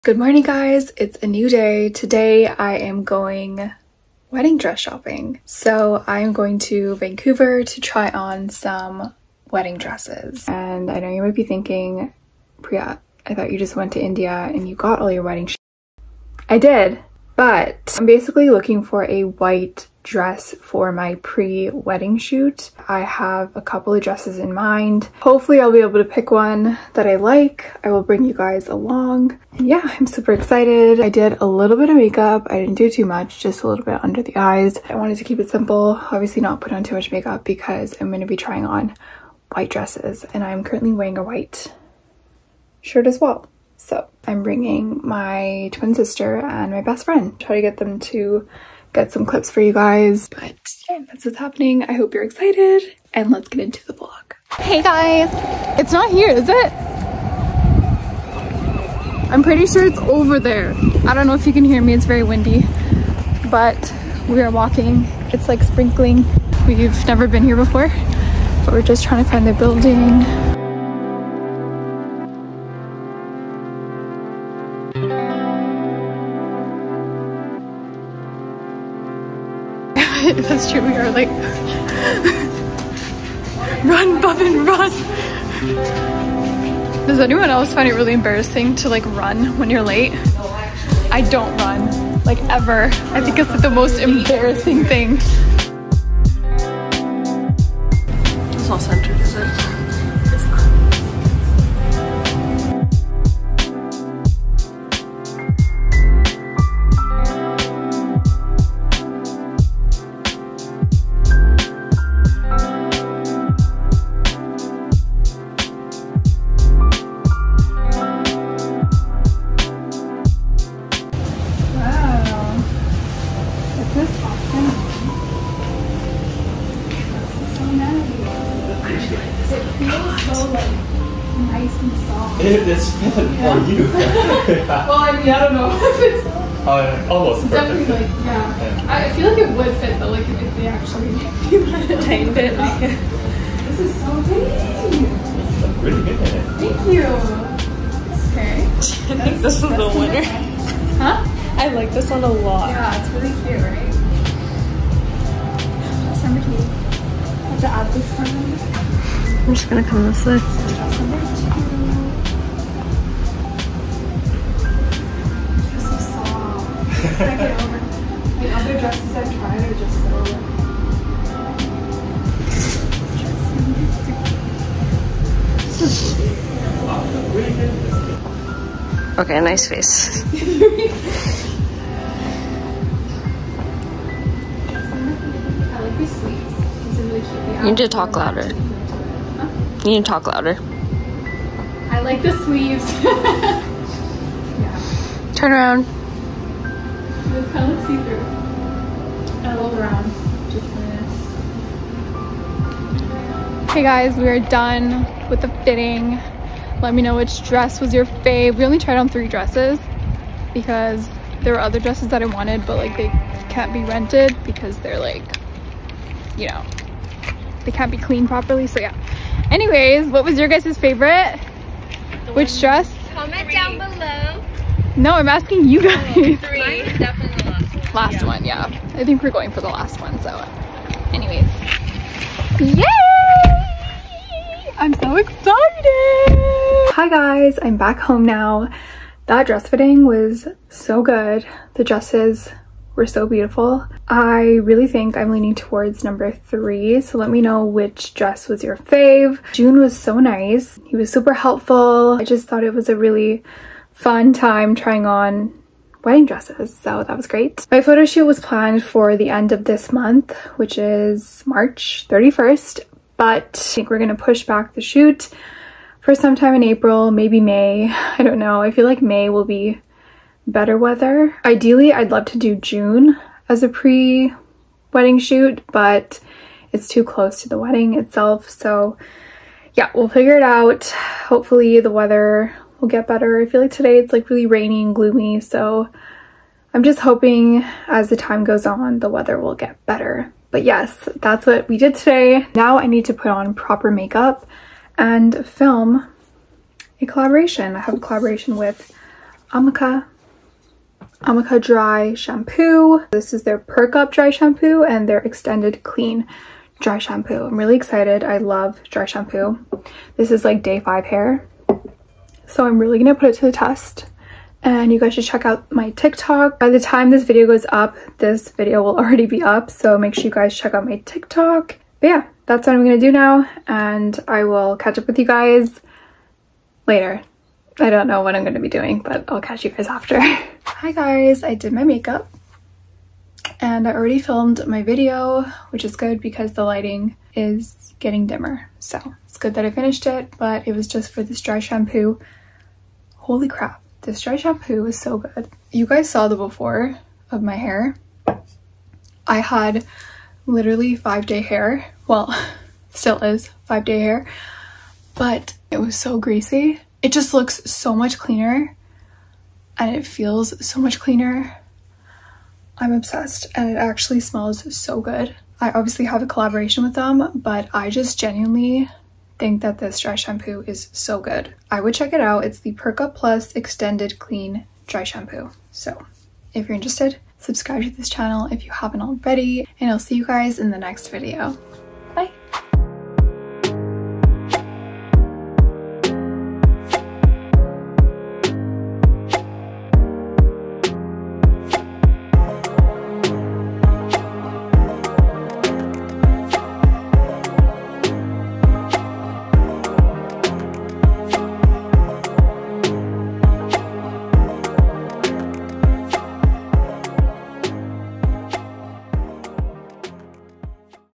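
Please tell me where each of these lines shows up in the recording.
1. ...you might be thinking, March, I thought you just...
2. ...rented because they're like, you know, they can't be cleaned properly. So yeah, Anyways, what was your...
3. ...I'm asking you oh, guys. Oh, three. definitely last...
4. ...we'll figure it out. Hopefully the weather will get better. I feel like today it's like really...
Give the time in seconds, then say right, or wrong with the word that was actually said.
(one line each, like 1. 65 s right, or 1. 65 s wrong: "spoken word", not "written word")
1. 11 s wrong: "Prya", not "March"
2. 213 s right
3. 225 s right
4. 279 s right.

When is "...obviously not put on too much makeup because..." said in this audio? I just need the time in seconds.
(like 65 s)
36 s.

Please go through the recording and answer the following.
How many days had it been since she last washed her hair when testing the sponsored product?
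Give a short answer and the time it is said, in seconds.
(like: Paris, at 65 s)
5, at 310 s.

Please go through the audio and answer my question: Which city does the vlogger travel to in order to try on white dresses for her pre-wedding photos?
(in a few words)
Vancouver.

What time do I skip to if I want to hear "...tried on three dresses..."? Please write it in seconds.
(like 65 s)
208 s.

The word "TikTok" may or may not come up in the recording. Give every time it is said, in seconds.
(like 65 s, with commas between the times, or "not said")
315 s, 321 s.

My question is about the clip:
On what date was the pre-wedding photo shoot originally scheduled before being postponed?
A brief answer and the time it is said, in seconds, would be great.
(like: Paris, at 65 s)
March 31st, at 261 s.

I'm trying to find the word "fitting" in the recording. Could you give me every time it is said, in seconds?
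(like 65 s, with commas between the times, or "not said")
205 s, 239 s.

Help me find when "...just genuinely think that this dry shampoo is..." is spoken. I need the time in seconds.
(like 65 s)
367 s.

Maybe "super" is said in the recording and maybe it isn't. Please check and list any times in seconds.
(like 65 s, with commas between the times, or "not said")
30 s, 251 s.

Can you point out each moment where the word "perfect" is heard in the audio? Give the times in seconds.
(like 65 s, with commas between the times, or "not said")
132 s, 137 s.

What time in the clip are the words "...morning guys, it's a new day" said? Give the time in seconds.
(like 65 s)
0 s.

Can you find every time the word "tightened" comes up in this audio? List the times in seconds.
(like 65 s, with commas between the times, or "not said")
142 s.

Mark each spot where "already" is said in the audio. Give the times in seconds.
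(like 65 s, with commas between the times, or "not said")
318 s, 333 s, 379 s.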